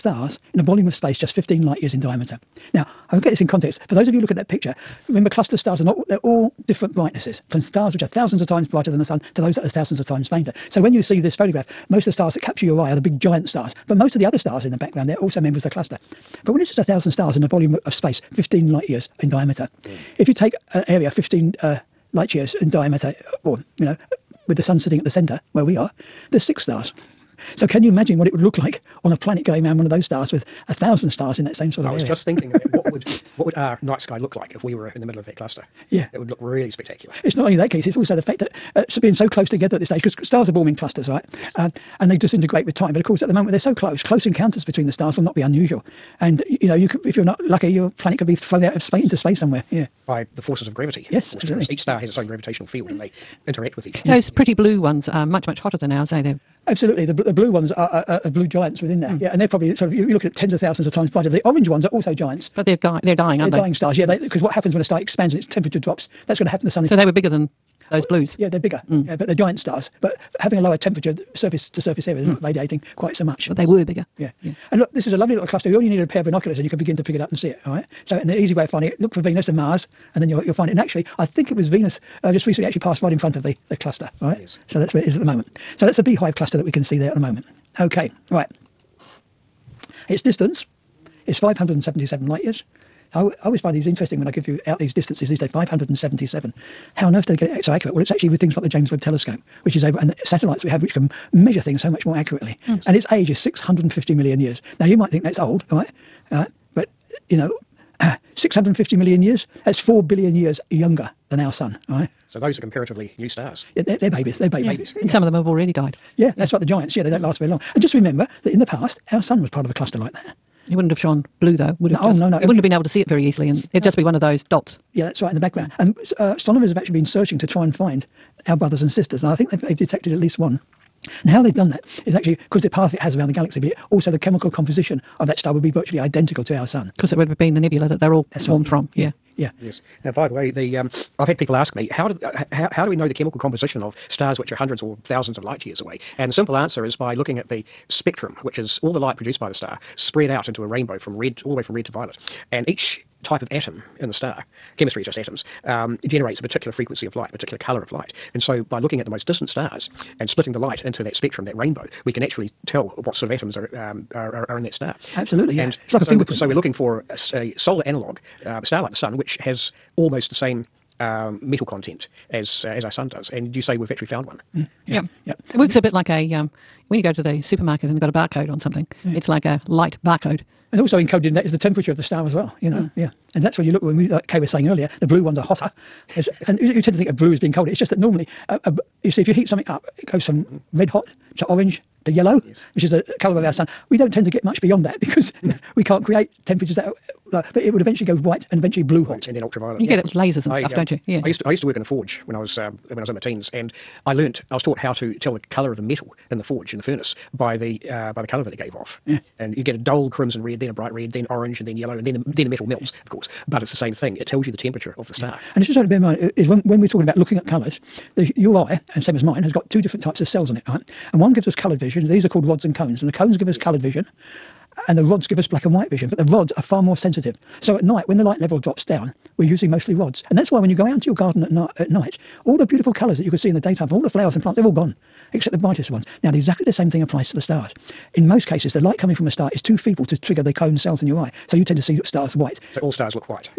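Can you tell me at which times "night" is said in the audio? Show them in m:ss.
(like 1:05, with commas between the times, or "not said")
0:33, 3:47, 3:51.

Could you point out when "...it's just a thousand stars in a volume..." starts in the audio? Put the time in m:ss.
0:16.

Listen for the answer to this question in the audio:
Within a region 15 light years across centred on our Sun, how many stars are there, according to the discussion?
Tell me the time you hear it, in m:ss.
0:26.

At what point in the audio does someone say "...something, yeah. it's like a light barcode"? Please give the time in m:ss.
2:58.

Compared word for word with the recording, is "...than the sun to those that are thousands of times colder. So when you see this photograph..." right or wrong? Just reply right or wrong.
wrong.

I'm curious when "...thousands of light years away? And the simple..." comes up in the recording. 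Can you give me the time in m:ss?
2:25.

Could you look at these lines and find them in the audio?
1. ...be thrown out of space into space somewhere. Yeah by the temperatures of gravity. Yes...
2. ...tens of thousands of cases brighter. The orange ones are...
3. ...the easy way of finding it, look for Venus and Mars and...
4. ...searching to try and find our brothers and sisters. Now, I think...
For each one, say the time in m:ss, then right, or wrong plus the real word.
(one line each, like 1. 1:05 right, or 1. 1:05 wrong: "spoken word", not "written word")
1. 0:48 wrong: "forces", not "temperatures"
2. 1:00 wrong: "times", not "cases"
3. 1:18 right
4. 2:07 right.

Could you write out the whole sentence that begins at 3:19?
get it with lasers and I, stuff, um, don't you?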